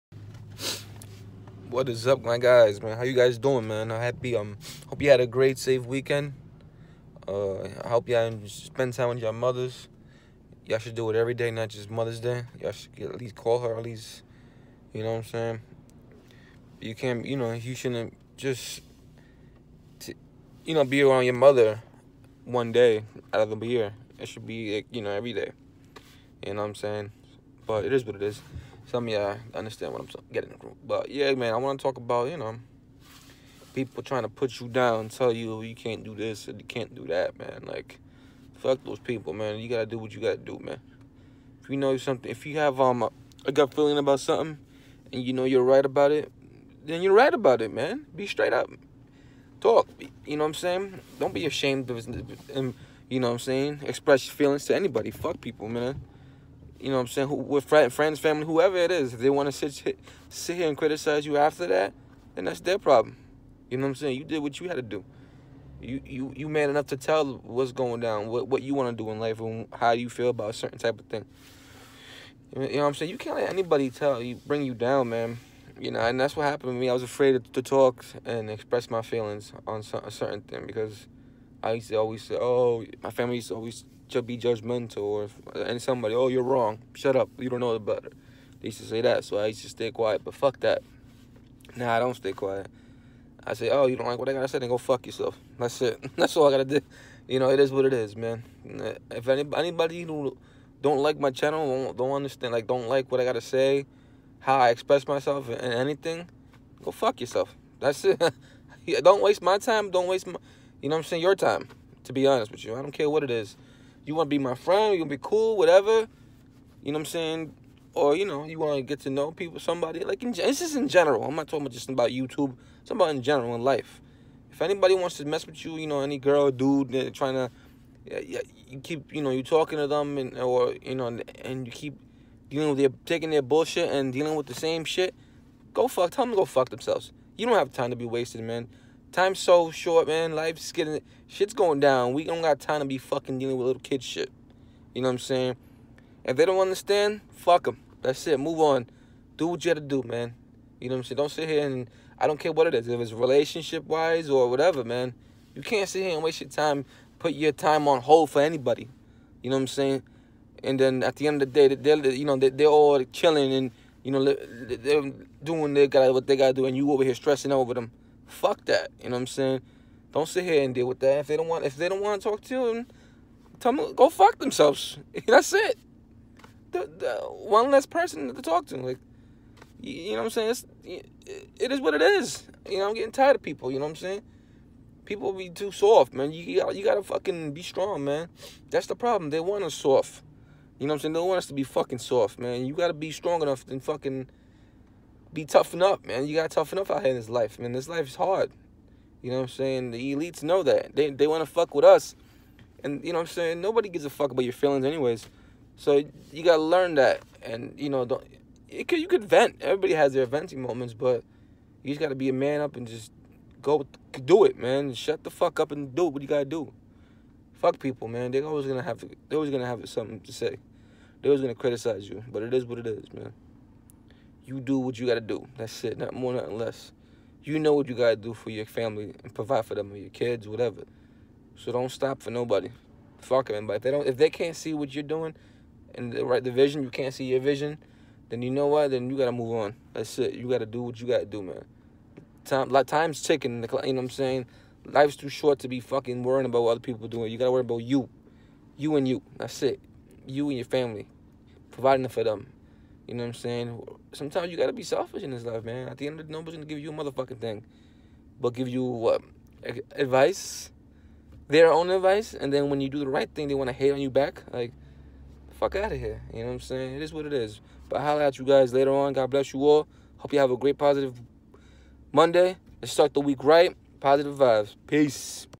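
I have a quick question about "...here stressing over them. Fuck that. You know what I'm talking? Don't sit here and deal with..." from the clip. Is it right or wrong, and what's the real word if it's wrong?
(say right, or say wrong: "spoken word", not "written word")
wrong: "saying", not "talking".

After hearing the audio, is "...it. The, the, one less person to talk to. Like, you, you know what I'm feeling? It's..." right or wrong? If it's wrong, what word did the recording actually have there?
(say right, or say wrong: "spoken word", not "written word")
wrong: "saying", not "feeling".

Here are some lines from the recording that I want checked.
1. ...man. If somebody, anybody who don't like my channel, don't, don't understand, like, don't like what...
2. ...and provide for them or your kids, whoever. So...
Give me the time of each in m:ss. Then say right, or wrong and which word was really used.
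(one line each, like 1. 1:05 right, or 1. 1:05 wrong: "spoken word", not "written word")
1. 1:38 wrong: "anybody", not "somebody"
2. 3:49 wrong: "whatever", not "whoever".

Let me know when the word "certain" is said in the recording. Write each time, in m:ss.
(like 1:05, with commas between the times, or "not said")
1:10, 1:20.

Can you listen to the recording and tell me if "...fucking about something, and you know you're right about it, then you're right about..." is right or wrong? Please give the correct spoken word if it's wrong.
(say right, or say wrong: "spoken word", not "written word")
wrong: "feeling", not "fucking".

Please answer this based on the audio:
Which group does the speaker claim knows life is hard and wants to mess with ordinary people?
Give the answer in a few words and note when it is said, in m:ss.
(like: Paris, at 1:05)
The elites, at 3:19.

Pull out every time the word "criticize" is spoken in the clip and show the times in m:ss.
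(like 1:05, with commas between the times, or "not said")
1:00, 3:41.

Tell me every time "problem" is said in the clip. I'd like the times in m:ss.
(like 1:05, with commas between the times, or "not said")
1:02, 3:08.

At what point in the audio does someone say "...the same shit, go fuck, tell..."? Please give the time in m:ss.
2:14.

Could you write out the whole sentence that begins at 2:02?
It's about in general, in life.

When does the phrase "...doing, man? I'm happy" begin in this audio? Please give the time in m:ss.
0:03.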